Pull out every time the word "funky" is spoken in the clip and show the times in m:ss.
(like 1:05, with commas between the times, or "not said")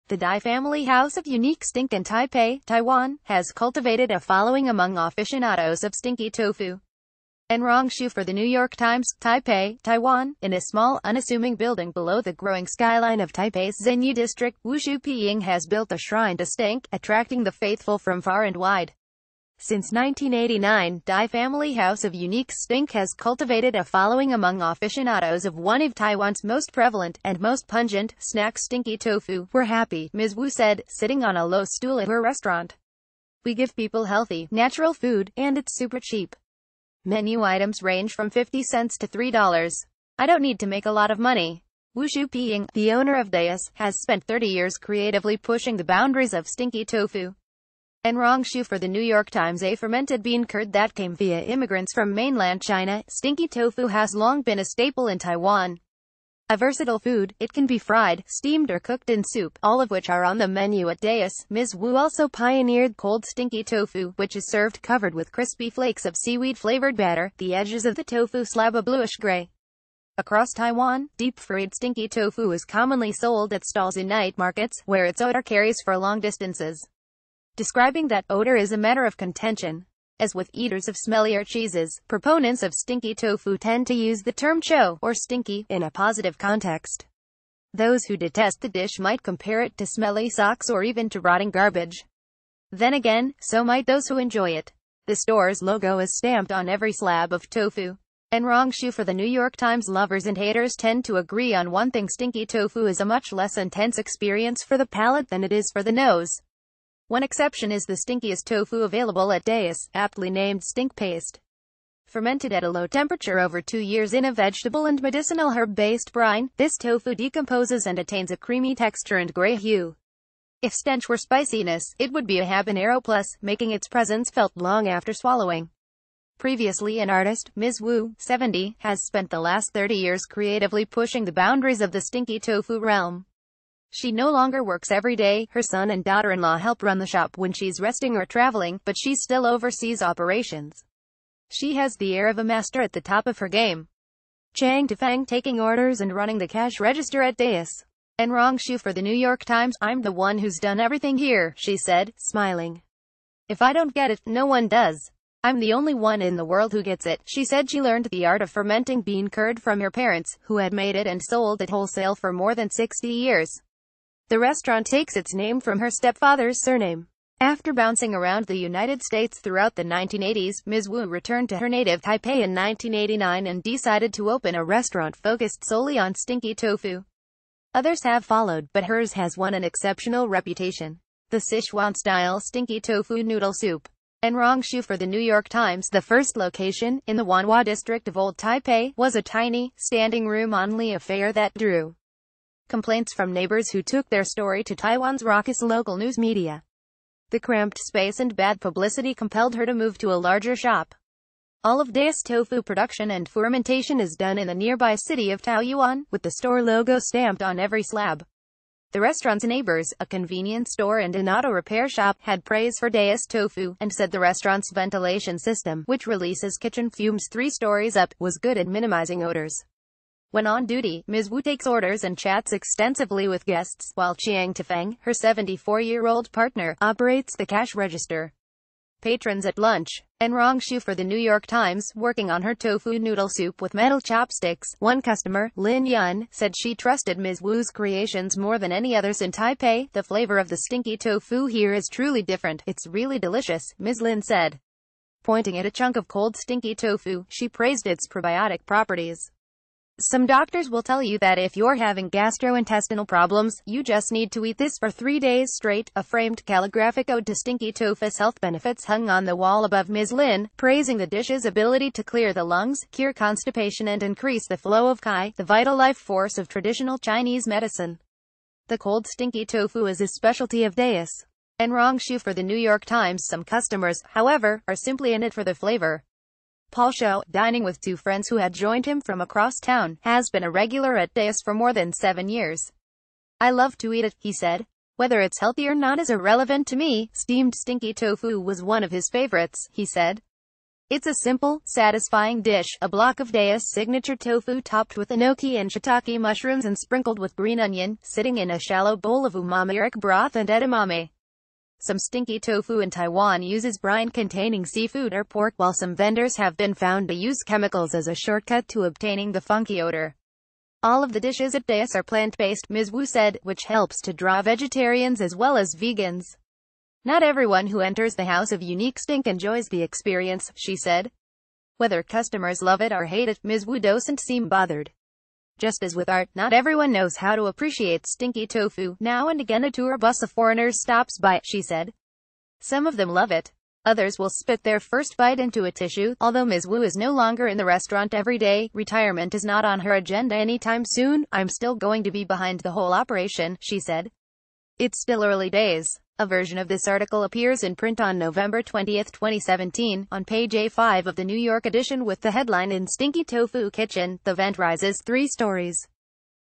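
5:09.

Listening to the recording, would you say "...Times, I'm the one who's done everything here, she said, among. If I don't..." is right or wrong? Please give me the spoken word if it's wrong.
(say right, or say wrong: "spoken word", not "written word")
wrong: "smiling", not "among".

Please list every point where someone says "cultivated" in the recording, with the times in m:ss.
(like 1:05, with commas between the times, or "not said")
0:03, 0:23.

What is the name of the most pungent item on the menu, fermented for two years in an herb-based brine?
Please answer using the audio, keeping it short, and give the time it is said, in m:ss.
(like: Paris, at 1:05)
stink paste, at 1:50.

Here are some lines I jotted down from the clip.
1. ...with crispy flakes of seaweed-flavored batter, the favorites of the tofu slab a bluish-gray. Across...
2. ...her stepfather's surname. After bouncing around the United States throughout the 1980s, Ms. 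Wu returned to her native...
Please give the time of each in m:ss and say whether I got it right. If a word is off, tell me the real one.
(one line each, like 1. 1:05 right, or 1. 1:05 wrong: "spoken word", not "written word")
1. 1:05 wrong: "edges", not "favorites"
2. 2:45 right.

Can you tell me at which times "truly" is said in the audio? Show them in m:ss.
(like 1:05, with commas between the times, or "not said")
4:01.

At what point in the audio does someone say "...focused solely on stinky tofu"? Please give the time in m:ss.
2:55.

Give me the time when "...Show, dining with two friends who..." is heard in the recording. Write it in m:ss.
4:36.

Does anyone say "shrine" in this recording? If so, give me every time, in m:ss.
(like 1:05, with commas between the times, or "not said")
0:15.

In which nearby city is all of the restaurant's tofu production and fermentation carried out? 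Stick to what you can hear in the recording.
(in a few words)
Taoyuan.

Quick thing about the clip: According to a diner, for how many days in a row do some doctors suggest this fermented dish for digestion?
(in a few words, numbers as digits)
3.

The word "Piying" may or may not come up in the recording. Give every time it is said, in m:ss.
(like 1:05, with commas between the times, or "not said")
0:14, 0:42.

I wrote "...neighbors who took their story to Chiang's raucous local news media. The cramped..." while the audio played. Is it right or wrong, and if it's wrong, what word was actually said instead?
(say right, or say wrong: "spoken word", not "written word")
wrong: "Taiwan", not "Chiang".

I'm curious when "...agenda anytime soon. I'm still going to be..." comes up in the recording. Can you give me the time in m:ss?
5:39.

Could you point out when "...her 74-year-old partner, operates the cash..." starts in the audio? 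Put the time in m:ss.
3:45.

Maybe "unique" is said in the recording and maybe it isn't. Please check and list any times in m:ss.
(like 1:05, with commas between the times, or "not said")
0:01, 0:22, 5:18.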